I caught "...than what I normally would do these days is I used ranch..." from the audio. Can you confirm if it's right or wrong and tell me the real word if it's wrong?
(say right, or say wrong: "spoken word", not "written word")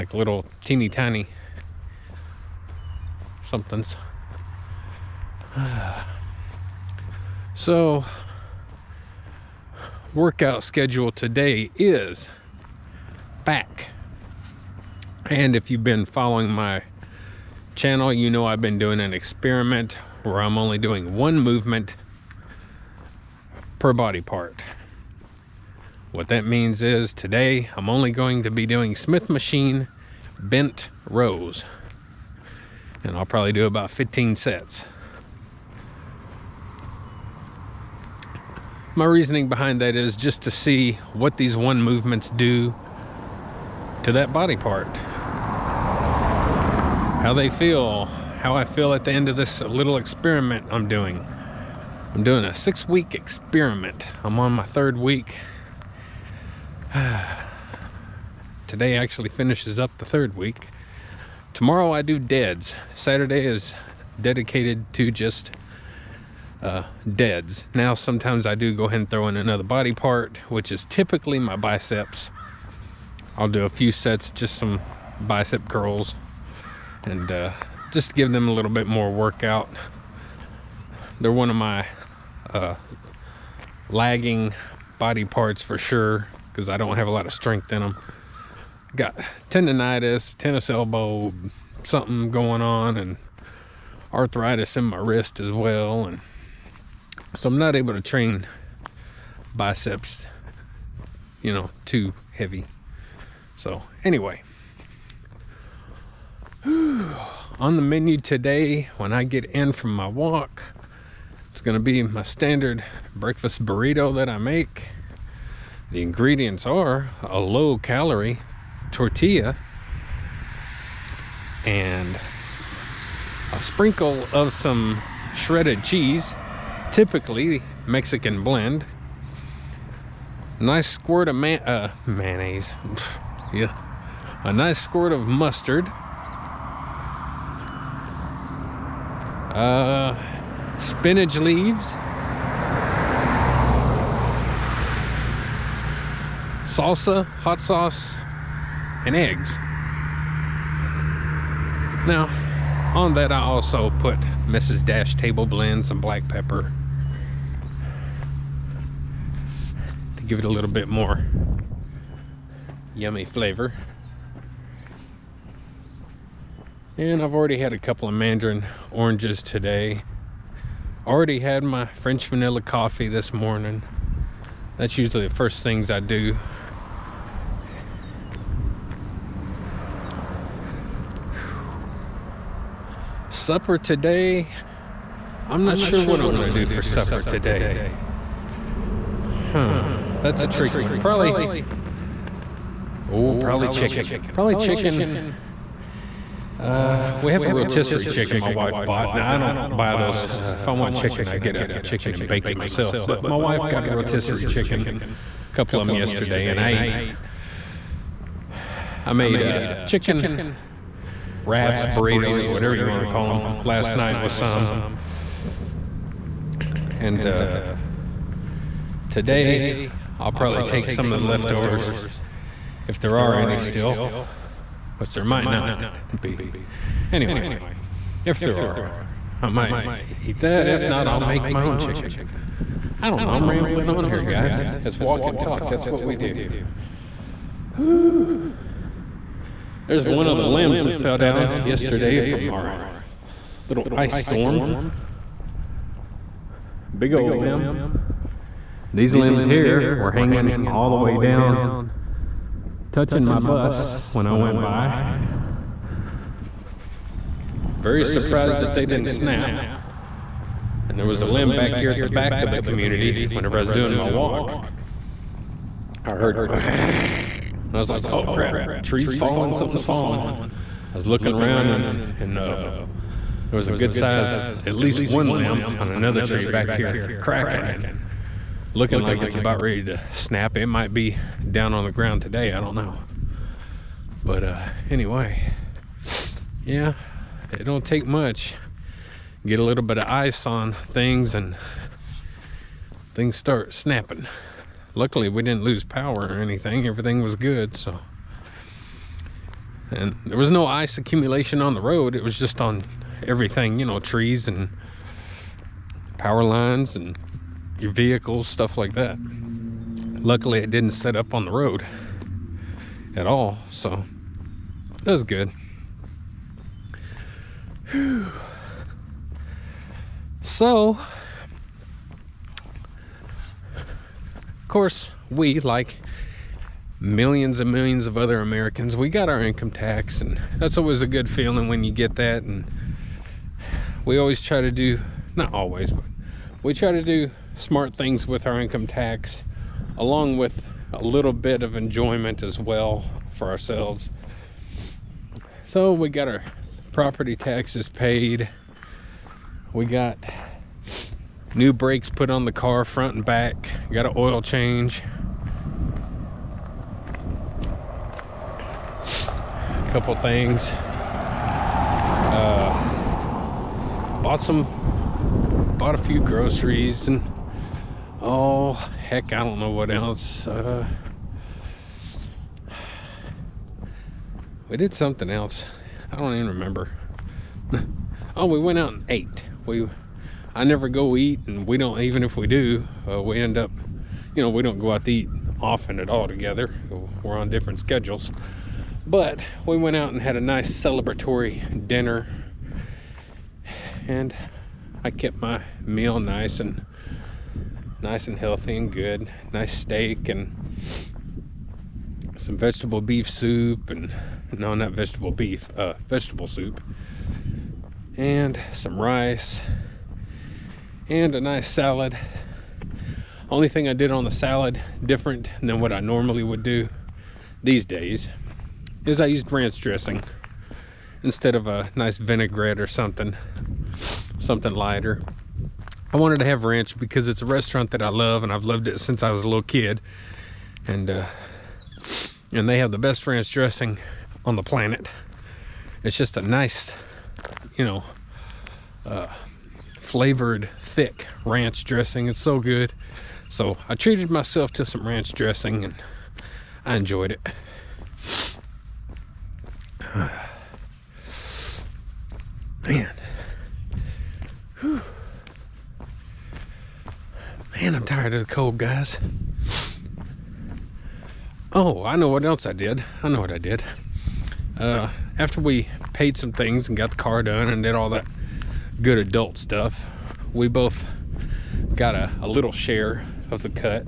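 right.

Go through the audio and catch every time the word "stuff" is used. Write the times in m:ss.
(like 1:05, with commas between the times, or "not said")
5:08, 7:49.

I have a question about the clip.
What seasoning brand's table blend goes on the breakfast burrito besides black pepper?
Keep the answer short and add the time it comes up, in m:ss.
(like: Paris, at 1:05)
Mrs. Dash, at 2:34.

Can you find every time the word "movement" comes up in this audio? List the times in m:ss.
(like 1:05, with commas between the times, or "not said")
0:21, 0:41.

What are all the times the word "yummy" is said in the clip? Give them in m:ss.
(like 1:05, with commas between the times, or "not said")
2:42.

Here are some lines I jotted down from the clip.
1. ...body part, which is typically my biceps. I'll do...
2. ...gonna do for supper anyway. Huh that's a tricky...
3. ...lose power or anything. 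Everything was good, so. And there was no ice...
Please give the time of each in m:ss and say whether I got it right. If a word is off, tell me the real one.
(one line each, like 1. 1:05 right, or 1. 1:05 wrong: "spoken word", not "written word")
1. 1:09 right
2. 3:06 wrong: "today", not "anyway"
3. 4:55 right.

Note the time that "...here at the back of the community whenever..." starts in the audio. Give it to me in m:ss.
4:21.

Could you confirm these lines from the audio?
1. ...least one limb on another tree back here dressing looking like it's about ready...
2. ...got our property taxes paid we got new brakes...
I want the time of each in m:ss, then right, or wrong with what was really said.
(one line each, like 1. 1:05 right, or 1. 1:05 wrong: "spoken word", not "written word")
1. 4:34 wrong: "cracking", not "dressing"
2. 5:46 right.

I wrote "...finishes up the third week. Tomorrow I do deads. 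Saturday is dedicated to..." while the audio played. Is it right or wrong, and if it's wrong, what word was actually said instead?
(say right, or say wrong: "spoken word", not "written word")
right.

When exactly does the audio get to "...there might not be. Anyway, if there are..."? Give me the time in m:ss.
3:45.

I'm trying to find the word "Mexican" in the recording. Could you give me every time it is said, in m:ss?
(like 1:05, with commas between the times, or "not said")
2:07.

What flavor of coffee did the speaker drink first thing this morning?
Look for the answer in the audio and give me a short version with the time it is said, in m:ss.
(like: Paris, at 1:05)
French vanilla, at 2:51.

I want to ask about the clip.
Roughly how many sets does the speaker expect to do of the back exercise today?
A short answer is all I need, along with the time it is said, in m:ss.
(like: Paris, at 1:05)
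15, at 0:33.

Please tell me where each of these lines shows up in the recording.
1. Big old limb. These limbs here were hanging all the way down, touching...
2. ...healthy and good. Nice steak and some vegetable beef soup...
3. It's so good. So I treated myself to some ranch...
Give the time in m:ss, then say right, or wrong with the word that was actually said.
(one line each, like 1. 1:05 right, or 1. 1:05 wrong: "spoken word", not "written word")
1. 4:06 right
2. 6:38 right
3. 7:22 right.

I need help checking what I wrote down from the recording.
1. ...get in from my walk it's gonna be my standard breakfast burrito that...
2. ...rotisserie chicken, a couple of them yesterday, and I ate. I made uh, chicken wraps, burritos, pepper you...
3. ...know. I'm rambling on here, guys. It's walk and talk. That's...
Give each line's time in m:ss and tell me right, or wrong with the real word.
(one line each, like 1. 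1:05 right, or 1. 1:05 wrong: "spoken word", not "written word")
1. 1:49 right
2. 3:23 wrong: "whatever", not "pepper"
3. 3:53 right.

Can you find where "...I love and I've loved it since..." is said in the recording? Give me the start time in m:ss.
7:08.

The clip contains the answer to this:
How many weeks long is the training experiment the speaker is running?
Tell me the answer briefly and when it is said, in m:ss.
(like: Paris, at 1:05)
6, at 0:52.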